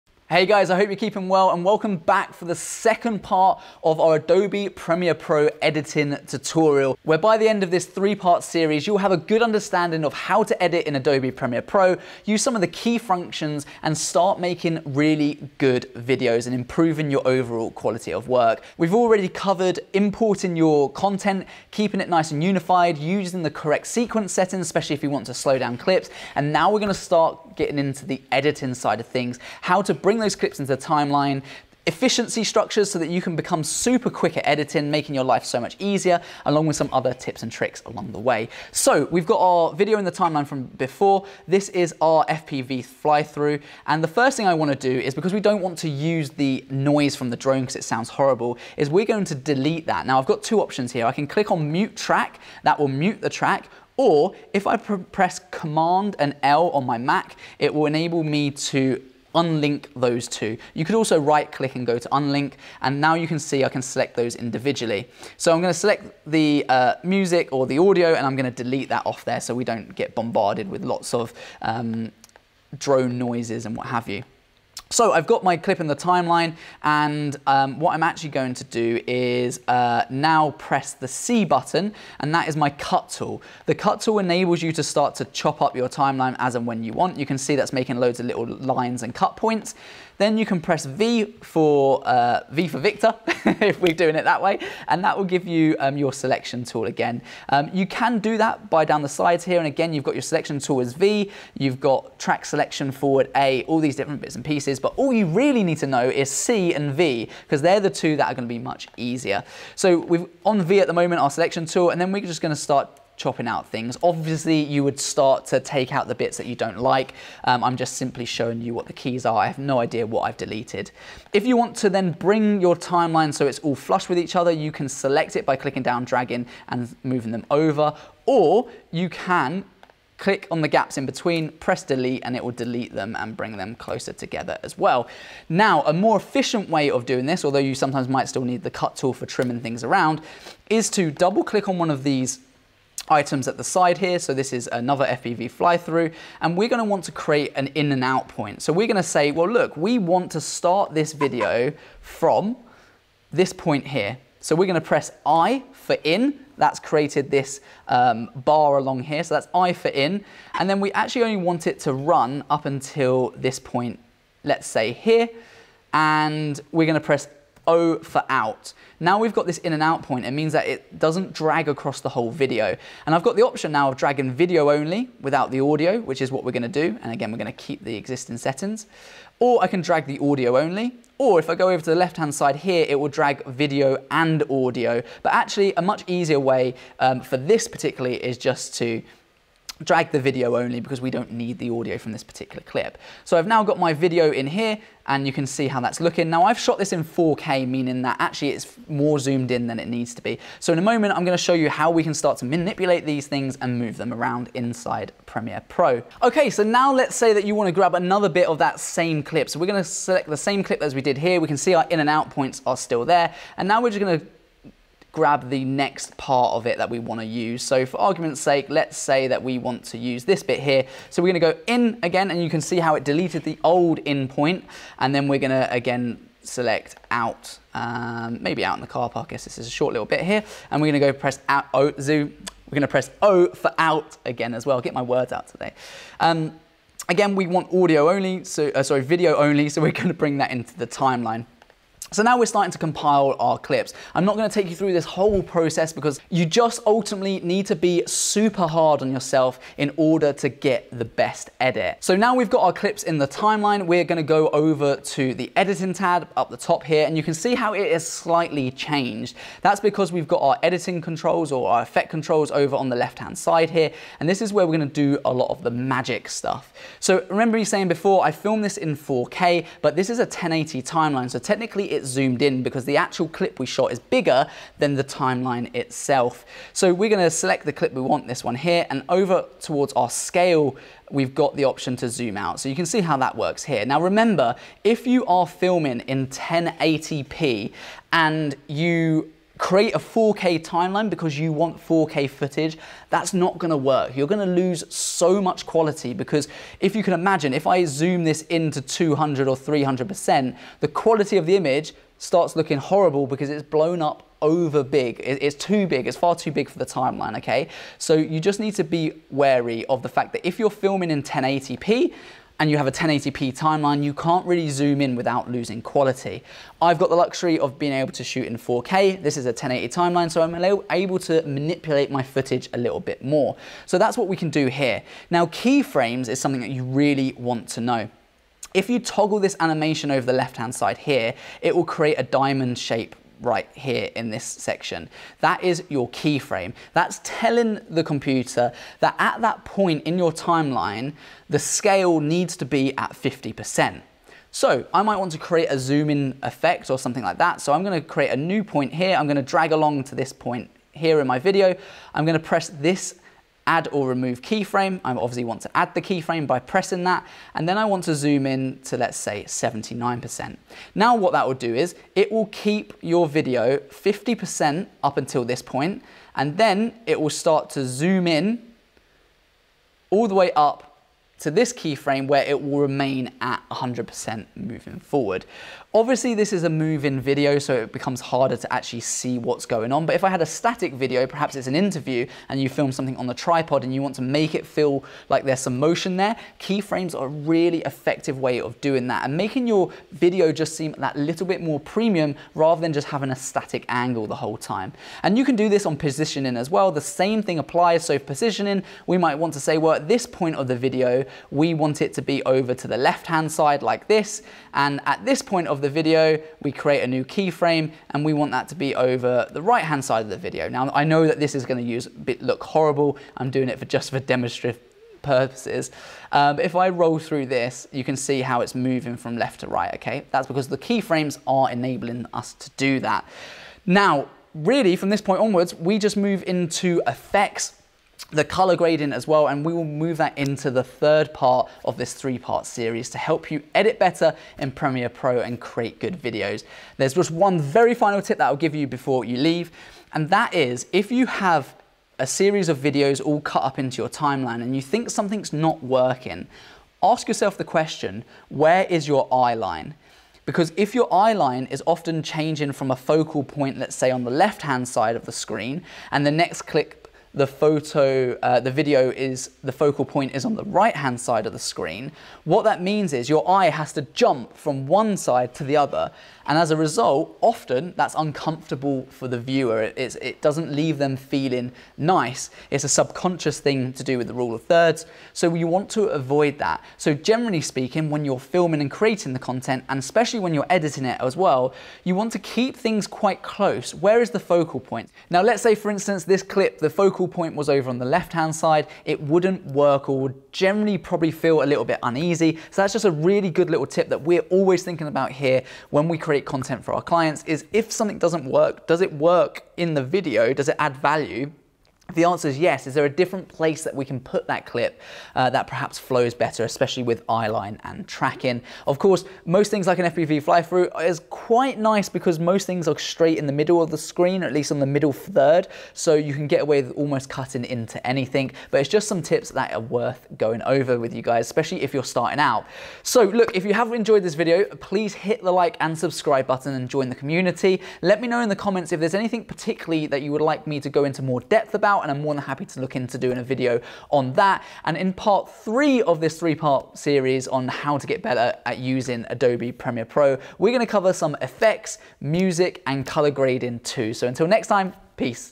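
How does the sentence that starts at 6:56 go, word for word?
Um, if I roll through this, you can see how it's moving from left to right, okay?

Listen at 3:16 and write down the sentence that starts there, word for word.
Now I've shot this in 4K, meaning that actually it's more zoomed in than it needs to be.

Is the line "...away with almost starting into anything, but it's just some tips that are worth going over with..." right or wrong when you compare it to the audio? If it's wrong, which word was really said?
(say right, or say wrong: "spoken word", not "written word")
wrong: "cutting", not "starting".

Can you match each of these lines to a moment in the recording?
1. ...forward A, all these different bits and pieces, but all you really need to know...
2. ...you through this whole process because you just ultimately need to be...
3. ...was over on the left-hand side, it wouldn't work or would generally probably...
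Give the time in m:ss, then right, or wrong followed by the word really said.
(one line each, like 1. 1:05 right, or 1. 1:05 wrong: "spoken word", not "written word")
1. 1:42 right
2. 4:04 right
3. 8:07 right.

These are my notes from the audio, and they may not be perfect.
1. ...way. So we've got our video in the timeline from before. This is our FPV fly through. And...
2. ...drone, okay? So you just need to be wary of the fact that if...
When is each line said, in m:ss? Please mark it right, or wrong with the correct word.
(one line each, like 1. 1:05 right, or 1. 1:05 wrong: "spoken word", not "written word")
1. 0:38 right
2. 5:06 wrong: "timeline", not "drone".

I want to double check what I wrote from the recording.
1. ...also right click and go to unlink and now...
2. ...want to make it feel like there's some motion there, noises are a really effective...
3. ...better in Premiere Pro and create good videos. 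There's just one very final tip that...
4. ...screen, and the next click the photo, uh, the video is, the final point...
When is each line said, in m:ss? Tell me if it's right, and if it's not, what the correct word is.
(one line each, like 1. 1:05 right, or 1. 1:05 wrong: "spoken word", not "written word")
1. 1:00 right
2. 6:24 wrong: "keyframes", not "noises"
3. 7:13 right
4. 7:35 wrong: "focal", not "final".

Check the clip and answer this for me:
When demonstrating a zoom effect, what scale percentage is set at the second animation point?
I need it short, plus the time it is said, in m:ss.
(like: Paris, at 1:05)
79%, at 5:59.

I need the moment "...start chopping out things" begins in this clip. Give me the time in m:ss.
1:52.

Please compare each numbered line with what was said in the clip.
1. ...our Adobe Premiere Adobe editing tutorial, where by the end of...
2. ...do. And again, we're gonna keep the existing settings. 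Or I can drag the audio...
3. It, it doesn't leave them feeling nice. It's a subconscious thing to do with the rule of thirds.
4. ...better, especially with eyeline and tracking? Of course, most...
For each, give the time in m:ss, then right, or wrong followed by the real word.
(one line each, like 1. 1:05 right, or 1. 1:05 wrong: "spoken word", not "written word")
1. 0:03 wrong: "Pro", not "Adobe"
2. 2:56 right
3. 7:49 right
4. 8:26 right.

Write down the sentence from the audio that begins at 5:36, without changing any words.
That's telling the computer that at that point in your timeline, the scale needs to be at 50%.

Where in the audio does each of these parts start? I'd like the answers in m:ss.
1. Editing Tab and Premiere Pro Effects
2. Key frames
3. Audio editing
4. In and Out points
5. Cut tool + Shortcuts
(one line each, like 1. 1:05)
1. 4:12
2. 5:25
3. 0:40
4. 2:20
5. 1:20.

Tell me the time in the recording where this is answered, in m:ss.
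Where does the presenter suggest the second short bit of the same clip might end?
3:48.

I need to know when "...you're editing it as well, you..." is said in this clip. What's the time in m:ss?
8:00.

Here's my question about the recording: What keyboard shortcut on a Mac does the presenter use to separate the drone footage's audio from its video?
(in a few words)
Command and L.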